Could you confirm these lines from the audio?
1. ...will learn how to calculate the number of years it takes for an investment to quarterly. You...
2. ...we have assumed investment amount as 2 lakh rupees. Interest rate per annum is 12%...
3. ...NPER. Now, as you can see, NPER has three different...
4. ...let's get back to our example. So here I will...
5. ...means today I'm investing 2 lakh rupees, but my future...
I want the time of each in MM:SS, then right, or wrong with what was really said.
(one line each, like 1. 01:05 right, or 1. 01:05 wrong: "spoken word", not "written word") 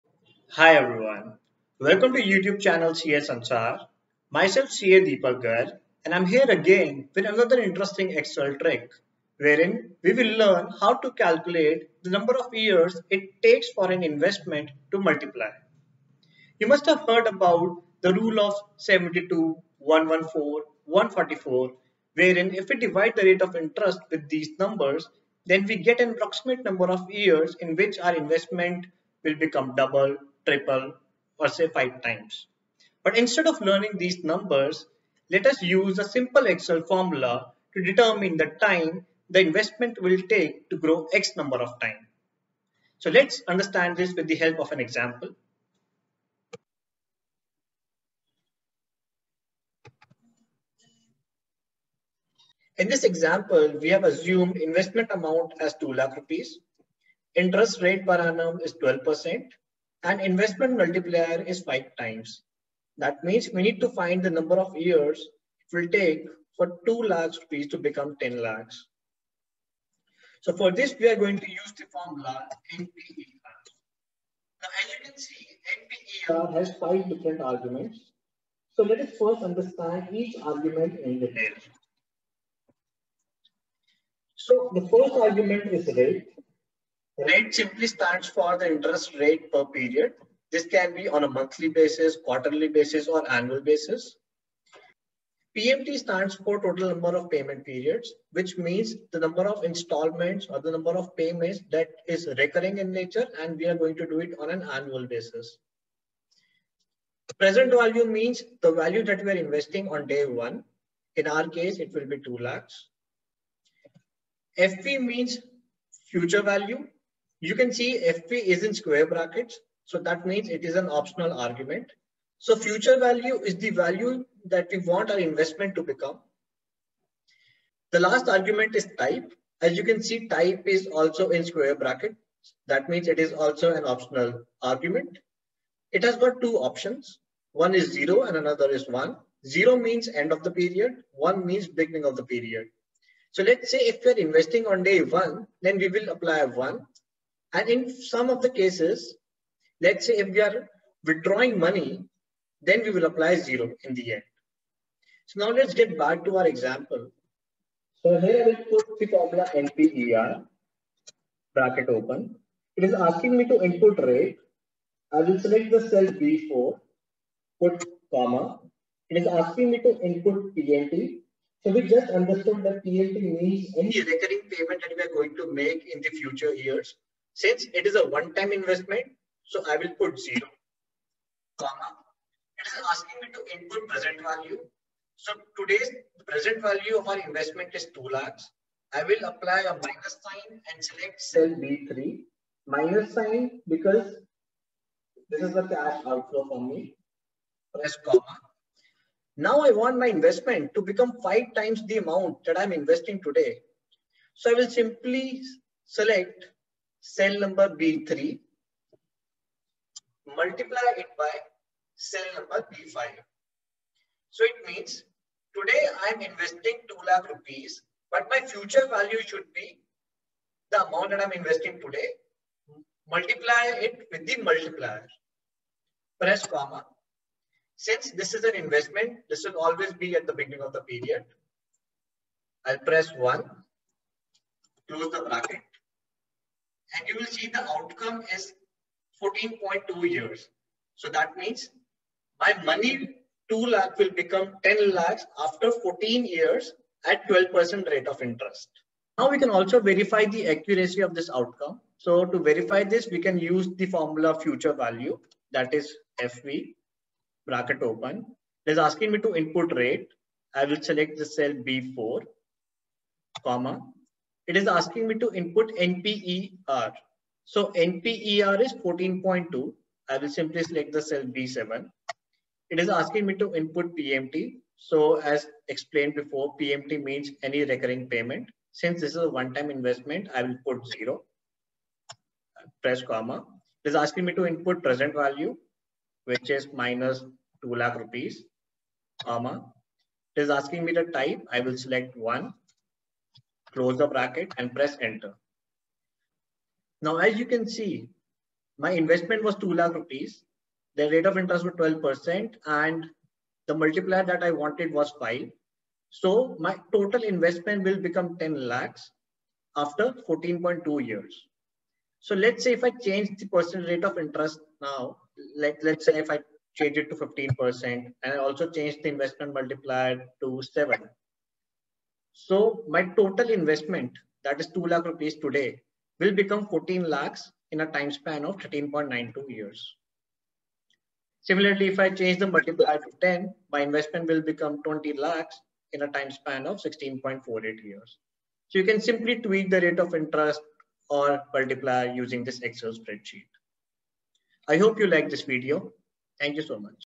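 1. 00:10 wrong: "multiply", not "quarterly"
2. 00:53 right
3. 01:12 wrong: "five", not "three"
4. 02:35 right
5. 03:34 right.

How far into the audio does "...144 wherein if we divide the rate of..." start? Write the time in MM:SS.
00:20.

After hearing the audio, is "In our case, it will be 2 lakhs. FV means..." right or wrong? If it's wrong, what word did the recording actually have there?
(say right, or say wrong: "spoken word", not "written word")
right.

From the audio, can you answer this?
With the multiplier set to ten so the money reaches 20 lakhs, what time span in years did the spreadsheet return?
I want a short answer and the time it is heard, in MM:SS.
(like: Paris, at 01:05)
16.48 years, at 05:36.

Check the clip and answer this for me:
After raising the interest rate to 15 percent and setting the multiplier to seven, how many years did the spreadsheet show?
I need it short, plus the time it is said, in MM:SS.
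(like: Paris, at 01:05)
13.92 years, at 05:28.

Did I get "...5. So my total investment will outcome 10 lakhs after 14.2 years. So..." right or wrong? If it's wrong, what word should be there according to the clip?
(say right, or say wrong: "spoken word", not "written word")
wrong: "become", not "outcome".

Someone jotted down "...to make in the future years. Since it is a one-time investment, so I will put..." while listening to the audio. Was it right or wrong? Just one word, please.
right.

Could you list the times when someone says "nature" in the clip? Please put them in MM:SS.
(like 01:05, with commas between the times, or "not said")
01:42.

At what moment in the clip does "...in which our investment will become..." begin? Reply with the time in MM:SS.
00:27.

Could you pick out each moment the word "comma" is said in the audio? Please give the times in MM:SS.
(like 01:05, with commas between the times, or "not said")
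02:48, 03:01, 03:18, 03:46, 04:23, 04:43, 04:49.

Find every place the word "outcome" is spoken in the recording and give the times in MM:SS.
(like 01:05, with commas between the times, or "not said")
03:57, 04:11.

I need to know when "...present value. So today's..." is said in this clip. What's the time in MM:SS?
03:03.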